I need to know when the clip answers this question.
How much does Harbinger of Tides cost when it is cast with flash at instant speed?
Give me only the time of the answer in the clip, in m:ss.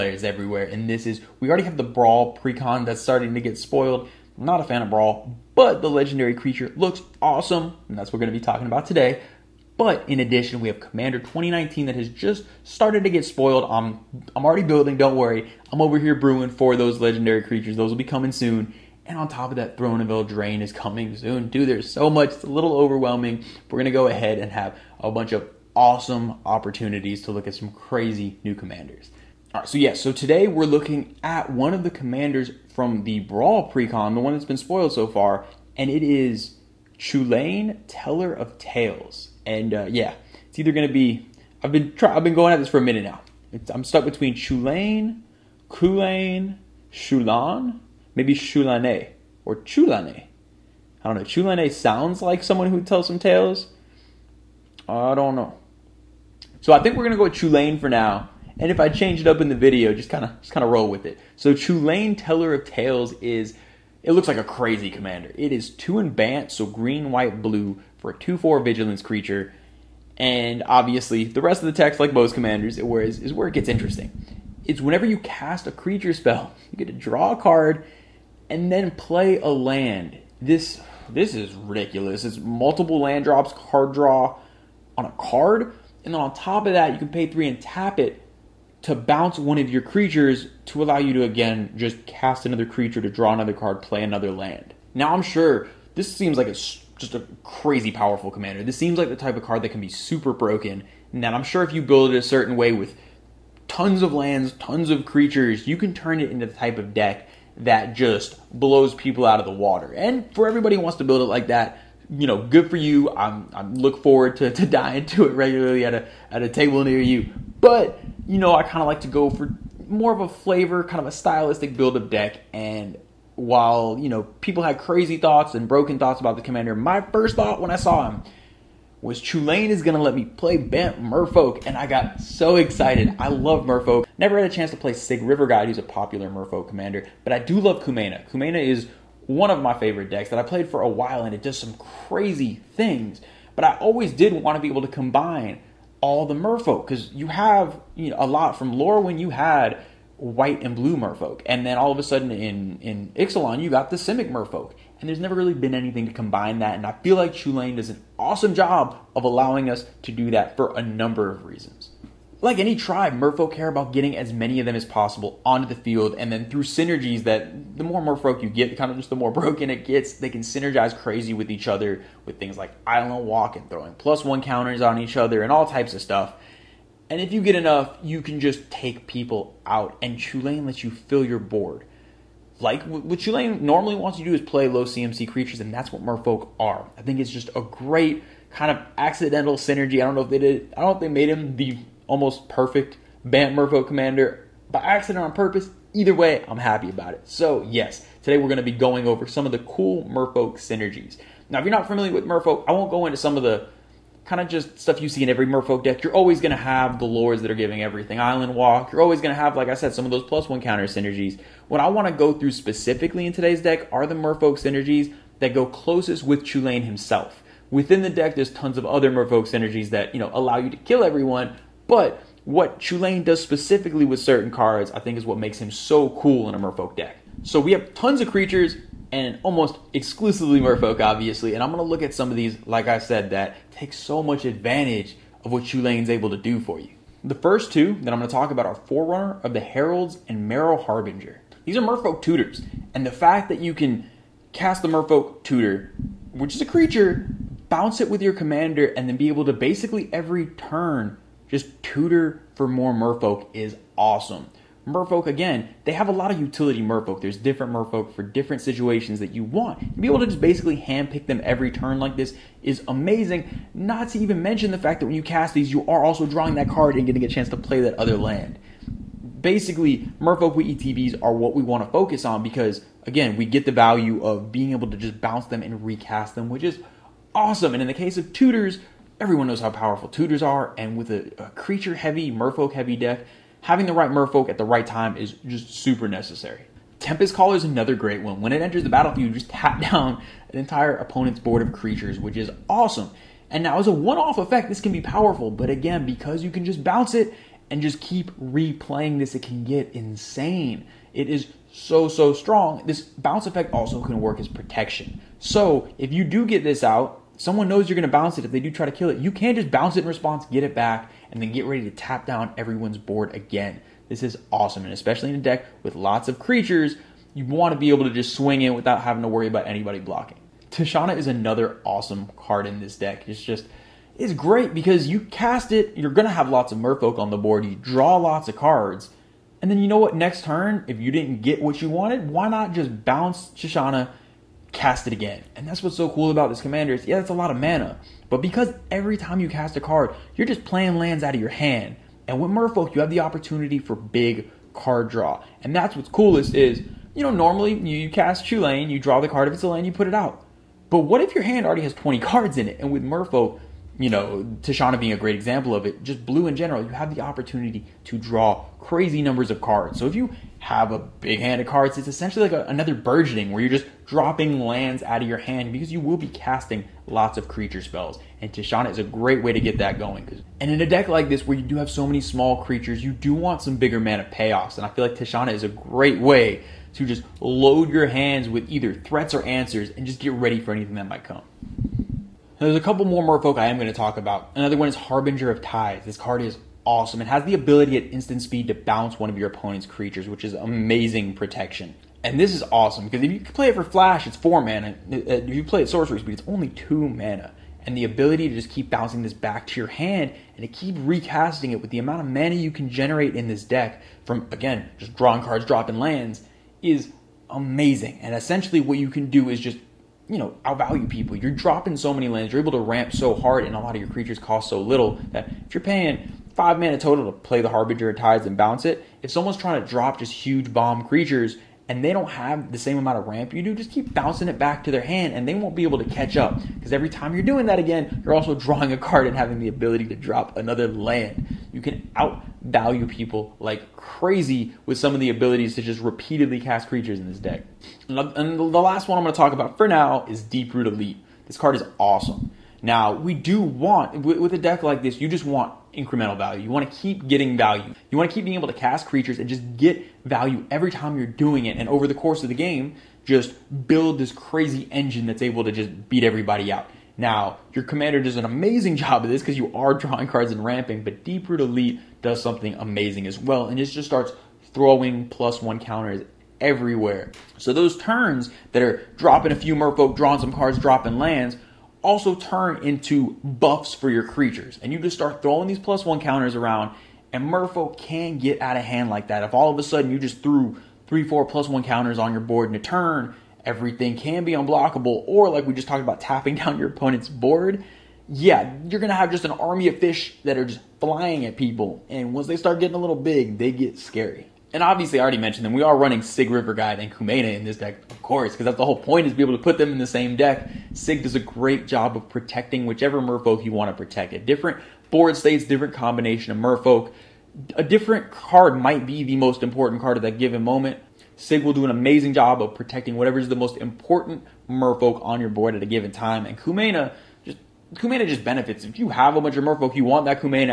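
6:34.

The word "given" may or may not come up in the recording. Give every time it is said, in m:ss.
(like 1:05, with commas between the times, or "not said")
8:30, 8:35.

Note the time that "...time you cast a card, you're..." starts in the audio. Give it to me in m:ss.
5:39.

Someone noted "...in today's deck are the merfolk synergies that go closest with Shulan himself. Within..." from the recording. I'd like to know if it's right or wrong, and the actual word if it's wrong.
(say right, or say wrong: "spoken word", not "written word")
wrong: "Chulane", not "Shulan".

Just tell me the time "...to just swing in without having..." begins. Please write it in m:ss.
5:18.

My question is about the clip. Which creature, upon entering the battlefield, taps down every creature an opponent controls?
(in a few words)
Tempest Caller.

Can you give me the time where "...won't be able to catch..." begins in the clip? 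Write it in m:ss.
7:05.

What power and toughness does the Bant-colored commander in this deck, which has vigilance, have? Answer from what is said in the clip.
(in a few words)
2/4.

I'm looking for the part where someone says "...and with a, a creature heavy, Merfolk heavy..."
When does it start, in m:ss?
4:40.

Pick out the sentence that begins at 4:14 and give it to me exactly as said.
Merfolk, again, they have a lot of utility Merfolk.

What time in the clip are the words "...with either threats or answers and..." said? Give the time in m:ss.
6:18.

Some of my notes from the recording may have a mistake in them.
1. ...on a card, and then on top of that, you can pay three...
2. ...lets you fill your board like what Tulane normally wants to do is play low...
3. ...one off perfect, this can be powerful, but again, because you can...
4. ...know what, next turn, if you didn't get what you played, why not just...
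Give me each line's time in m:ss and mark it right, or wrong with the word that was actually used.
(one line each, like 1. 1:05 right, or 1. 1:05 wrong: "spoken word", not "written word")
1. 1:24 right
2. 3:00 right
3. 4:53 wrong: "effect", not "perfect"
4. 5:29 wrong: "wanted", not "played".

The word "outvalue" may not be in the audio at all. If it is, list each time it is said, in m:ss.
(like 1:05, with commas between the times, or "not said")
6:50, 7:12.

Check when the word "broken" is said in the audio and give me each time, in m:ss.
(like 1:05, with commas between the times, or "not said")
1:40, 2:05, 2:49.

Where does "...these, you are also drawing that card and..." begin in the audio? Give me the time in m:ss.
4:25.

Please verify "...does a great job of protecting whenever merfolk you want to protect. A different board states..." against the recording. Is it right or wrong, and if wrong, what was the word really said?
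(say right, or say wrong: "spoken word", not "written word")
wrong: "whichever", not "whenever".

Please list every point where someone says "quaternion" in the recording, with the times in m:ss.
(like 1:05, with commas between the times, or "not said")
not said.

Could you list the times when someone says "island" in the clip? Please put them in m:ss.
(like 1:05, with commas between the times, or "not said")
2:52, 3:28.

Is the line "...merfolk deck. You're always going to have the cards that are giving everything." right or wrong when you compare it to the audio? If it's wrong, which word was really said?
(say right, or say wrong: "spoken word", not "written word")
wrong: "lords", not "cards".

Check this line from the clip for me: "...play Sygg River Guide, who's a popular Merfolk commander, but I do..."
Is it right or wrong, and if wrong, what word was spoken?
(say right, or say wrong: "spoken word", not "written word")
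right.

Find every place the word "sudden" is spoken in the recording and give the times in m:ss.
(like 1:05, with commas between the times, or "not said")
2:32, 7:59.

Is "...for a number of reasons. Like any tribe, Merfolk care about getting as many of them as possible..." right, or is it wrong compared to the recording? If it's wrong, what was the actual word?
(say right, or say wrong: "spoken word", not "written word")
right.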